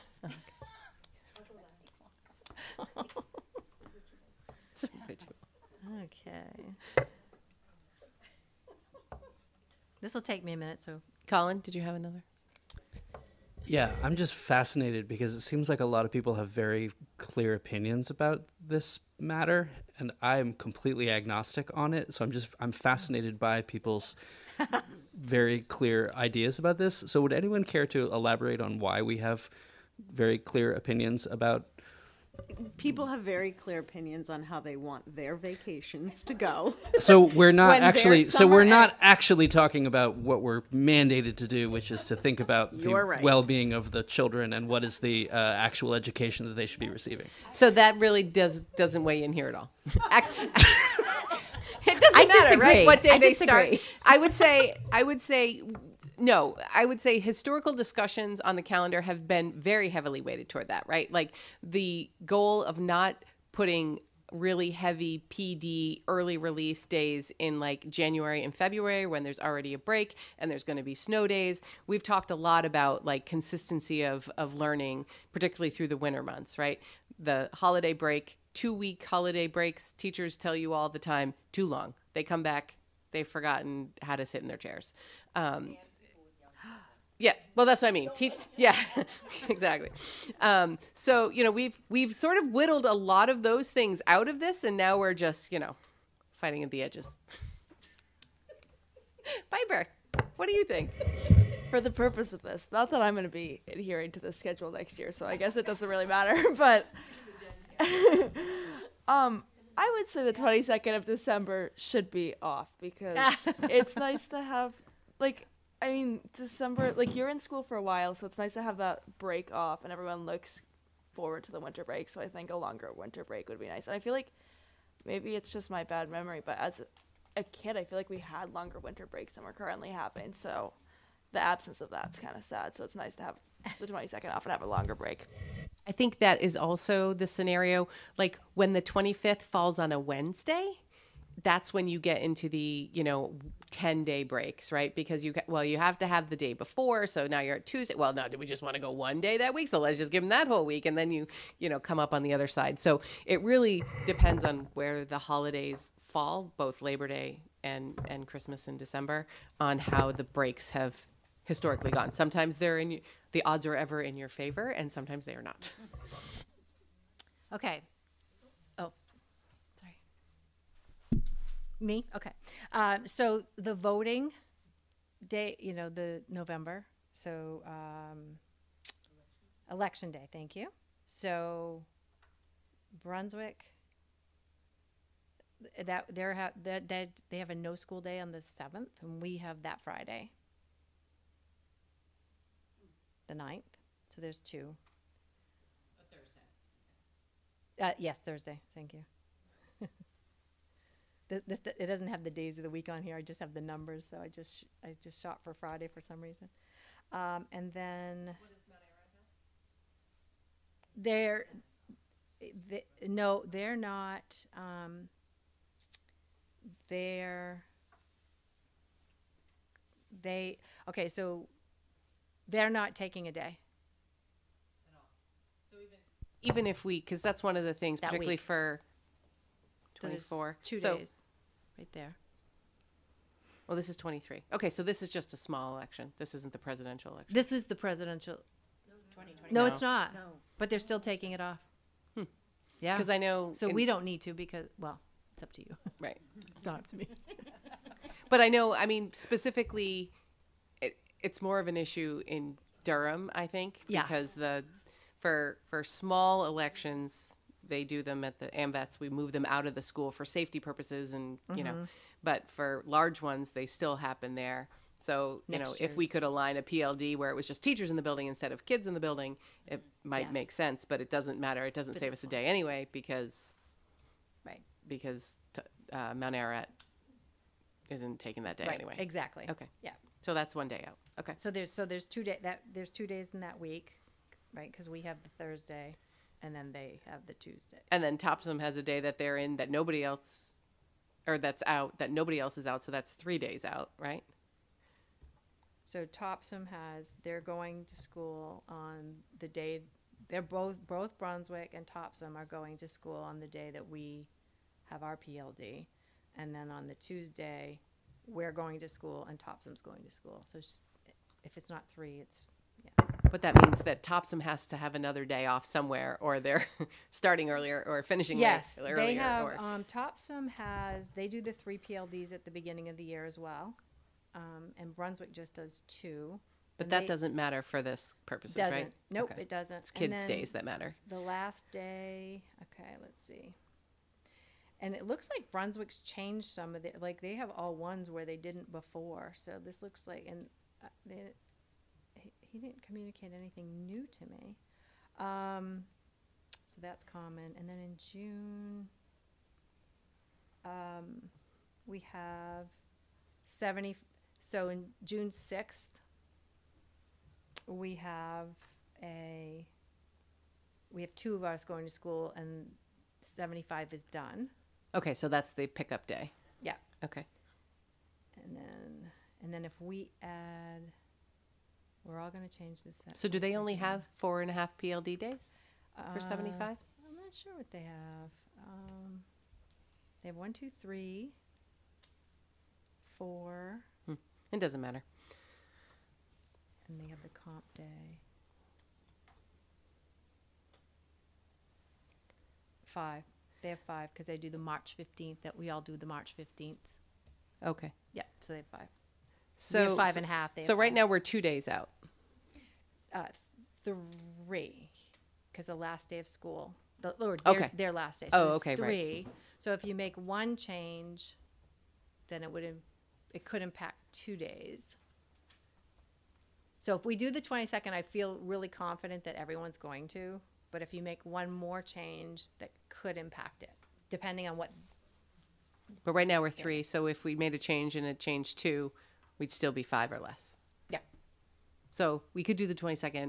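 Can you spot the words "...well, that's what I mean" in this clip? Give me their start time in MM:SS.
01:27.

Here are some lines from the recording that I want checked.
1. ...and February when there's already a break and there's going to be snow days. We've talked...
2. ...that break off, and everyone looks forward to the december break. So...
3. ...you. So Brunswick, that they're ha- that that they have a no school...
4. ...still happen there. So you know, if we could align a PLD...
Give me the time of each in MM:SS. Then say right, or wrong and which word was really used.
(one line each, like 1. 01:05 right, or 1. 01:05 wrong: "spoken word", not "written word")
1. 01:08 right
2. 01:58 wrong: "winter", not "december"
3. 03:00 right
4. 04:23 right.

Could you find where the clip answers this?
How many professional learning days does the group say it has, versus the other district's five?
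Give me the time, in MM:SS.
06:39.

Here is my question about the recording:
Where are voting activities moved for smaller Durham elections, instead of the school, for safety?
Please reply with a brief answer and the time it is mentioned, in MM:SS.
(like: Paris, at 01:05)
AMVETS, at 04:18.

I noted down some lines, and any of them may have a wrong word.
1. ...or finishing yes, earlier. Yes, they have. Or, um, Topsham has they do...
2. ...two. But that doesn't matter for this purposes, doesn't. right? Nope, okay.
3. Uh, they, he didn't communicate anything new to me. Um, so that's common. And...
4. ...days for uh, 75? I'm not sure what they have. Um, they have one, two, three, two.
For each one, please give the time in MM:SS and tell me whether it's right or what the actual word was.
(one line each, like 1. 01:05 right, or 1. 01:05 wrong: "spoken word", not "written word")
1. 05:17 right
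2. 05:25 right
3. 05:40 right
4. 06:15 wrong: "four", not "two".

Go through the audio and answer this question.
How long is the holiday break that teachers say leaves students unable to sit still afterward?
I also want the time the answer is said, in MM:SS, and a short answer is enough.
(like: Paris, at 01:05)
2 weeks, at 01:18.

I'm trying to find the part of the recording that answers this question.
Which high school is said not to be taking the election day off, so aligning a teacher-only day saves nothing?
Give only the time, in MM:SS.
04:36.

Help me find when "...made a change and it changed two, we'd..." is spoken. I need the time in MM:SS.
07:07.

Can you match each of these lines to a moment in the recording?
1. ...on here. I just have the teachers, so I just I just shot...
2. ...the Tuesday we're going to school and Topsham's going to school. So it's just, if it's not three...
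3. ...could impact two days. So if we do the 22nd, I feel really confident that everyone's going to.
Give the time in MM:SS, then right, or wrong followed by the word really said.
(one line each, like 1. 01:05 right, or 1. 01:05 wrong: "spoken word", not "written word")
1. 03:22 wrong: "numbers", not "teachers"
2. 05:06 right
3. 06:53 right.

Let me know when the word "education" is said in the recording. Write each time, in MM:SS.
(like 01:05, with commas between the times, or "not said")
00:45.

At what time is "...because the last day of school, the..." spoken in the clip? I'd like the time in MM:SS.
06:45.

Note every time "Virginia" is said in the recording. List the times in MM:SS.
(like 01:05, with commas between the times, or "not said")
not said.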